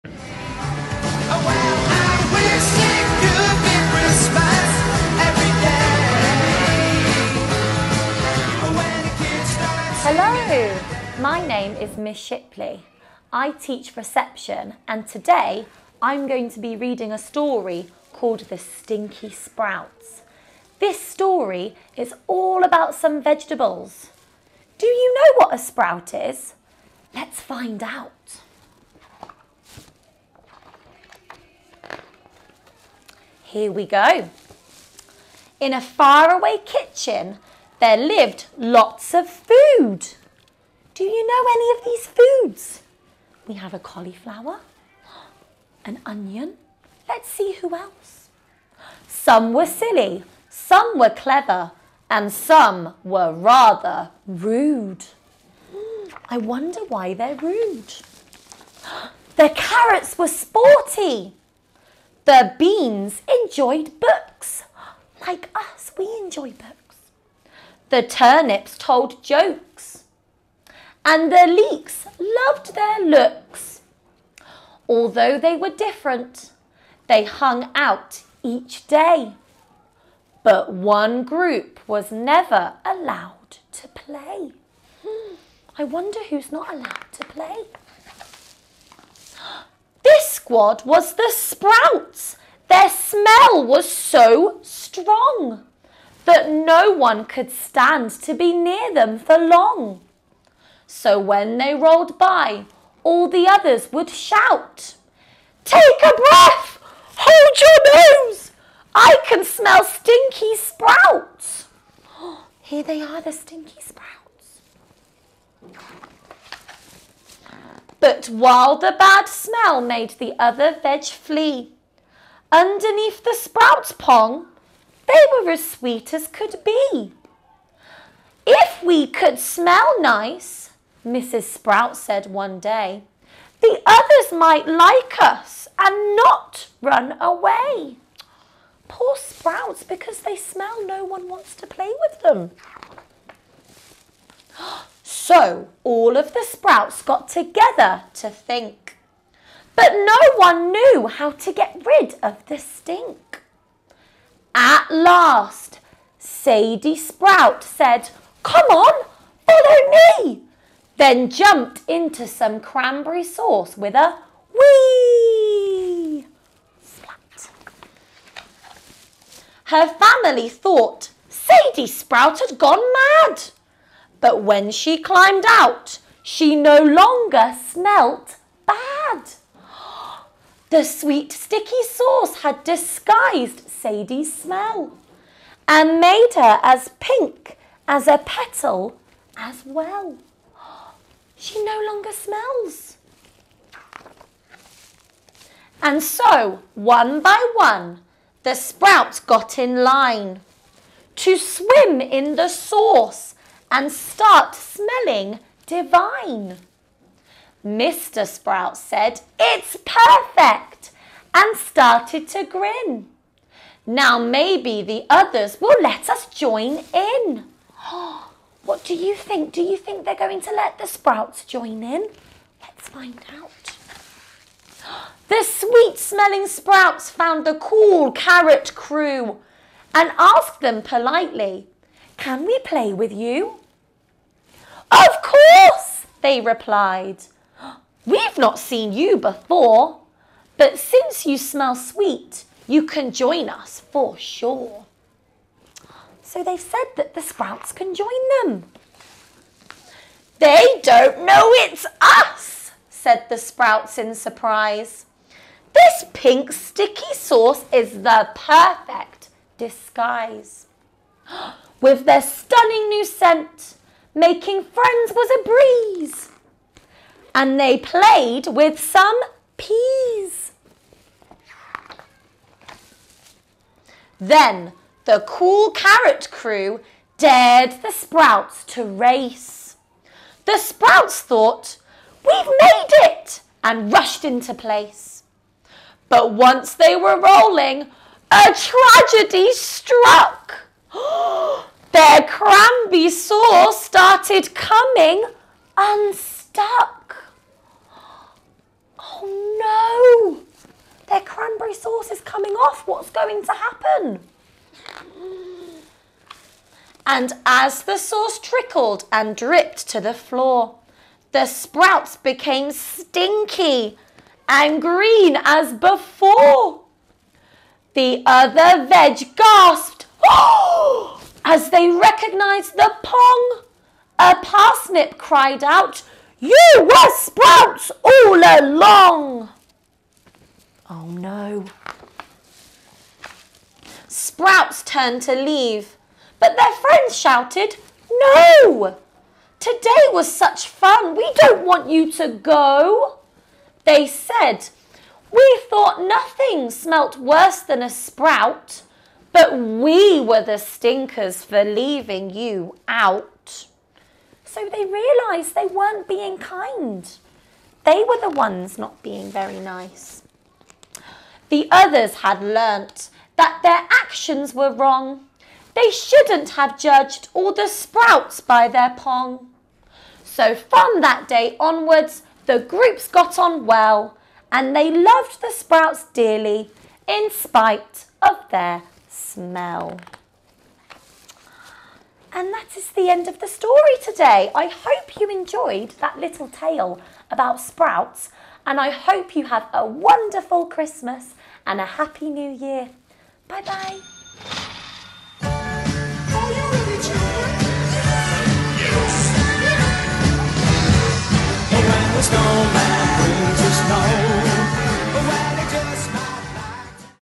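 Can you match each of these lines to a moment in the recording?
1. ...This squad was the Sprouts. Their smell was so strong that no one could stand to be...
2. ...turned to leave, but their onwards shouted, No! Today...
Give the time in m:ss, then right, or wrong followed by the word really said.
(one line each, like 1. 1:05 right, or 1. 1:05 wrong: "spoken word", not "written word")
1. 1:30 right
2. 5:34 wrong: "friends", not "onwards".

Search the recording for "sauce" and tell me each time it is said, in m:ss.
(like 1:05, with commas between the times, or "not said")
2:43, 3:01, 3:22, 4:17, 4:53, 5:01, 5:07.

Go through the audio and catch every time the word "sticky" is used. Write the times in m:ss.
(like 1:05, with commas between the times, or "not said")
3:01, 4:16.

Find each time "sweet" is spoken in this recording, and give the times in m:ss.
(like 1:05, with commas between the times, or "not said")
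2:05, 3:00, 3:45, 4:01.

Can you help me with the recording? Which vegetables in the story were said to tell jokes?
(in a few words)
Turnips.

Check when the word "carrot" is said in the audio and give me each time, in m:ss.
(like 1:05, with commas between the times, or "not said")
0:59, 3:48, 4:35.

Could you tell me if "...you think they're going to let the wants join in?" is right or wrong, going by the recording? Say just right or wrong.
wrong.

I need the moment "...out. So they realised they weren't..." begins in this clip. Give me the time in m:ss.
5:52.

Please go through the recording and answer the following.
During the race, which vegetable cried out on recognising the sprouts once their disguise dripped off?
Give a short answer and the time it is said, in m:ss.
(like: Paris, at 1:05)
A parsnip, at 5:24.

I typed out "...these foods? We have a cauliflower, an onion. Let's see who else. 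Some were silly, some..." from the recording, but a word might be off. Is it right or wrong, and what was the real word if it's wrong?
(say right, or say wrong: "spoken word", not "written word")
right.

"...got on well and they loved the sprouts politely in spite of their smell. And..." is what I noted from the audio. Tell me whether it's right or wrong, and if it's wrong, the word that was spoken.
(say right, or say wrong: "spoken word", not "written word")
wrong: "dearly", not "politely".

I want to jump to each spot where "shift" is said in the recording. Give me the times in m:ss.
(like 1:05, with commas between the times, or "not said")
not said.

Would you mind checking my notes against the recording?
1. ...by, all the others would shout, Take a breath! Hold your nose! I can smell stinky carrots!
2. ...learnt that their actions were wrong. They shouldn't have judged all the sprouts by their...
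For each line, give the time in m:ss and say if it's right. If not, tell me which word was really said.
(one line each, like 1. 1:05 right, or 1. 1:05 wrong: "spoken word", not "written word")
1. 1:42 wrong: "sprouts", not "carrots"
2. 6:02 right.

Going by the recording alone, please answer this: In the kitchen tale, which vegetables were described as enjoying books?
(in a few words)
The beans.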